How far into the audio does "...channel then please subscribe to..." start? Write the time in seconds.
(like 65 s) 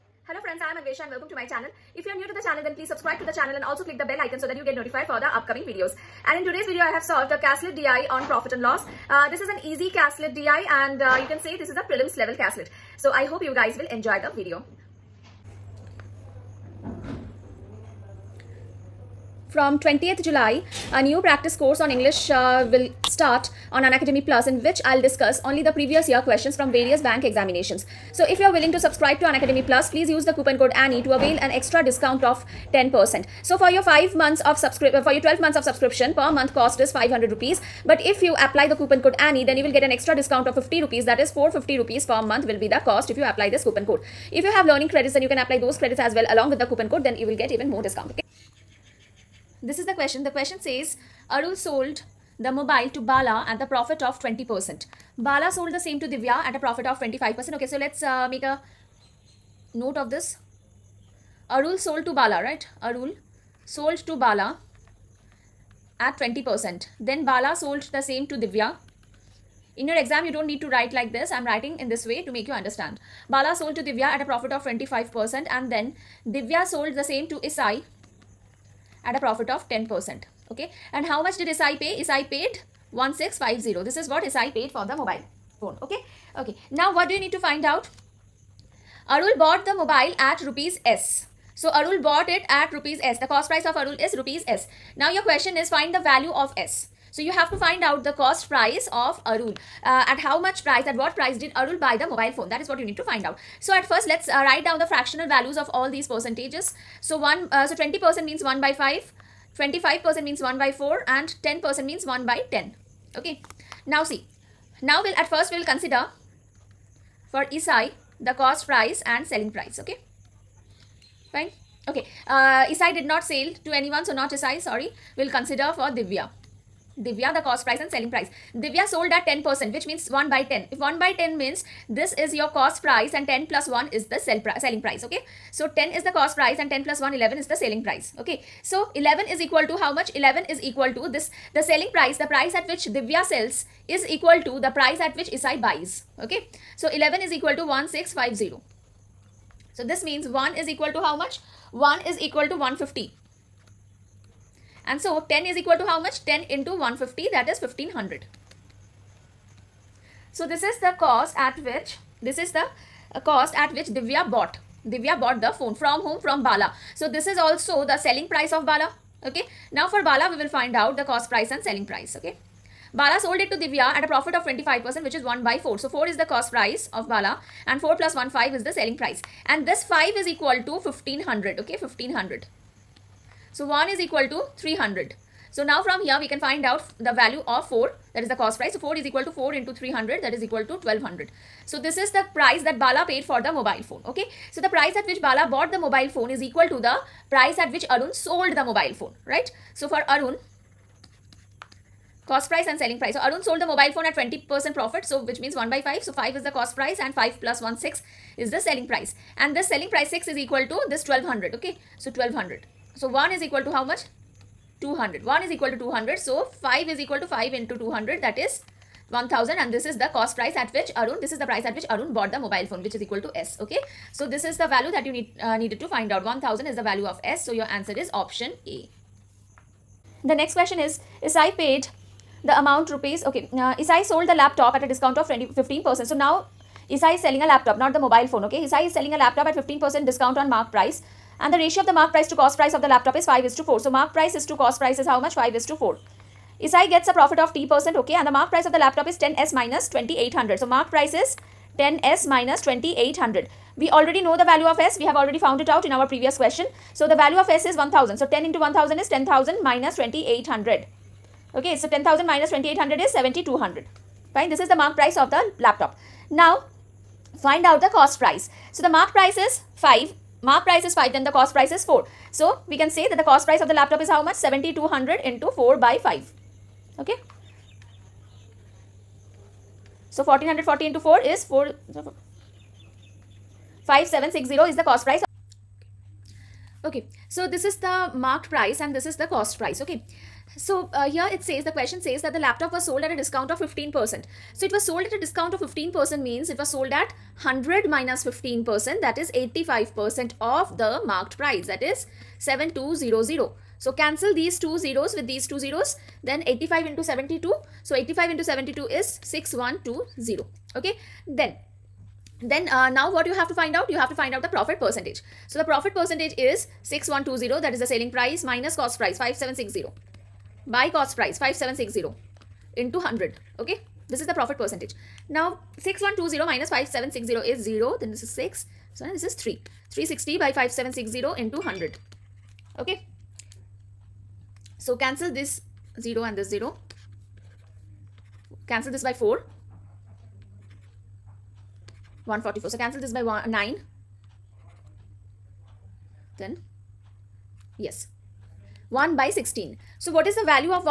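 2 s.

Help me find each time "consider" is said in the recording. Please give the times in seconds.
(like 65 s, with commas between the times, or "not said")
115 s, 125 s.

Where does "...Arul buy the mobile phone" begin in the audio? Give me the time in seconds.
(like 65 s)
101 s.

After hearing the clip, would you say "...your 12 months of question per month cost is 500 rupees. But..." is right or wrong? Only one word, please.
wrong.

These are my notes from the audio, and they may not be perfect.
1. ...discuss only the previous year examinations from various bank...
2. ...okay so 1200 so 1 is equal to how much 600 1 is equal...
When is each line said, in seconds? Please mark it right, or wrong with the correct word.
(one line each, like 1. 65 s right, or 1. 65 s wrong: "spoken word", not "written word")
1. 25 s wrong: "questions", not "examinations"
2. 211 s wrong: "200", not "600".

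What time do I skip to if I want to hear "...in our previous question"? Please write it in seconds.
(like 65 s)
255 s.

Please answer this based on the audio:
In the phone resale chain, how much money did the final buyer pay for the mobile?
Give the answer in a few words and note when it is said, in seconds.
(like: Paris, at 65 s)
1650, at 82 s.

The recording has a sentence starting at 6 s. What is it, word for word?
And in today's video I have solved a Caselet DI on profit and loss.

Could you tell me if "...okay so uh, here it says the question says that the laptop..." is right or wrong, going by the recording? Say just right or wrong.
right.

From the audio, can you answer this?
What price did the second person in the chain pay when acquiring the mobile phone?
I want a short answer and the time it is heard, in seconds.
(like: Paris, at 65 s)
1200, at 190 s.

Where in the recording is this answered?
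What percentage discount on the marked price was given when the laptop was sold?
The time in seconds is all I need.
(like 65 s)
239 s.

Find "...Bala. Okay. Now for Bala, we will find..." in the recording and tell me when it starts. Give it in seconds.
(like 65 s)
168 s.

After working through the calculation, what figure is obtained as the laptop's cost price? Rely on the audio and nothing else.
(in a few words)
5760.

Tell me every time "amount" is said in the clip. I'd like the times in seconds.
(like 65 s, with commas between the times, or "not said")
232 s.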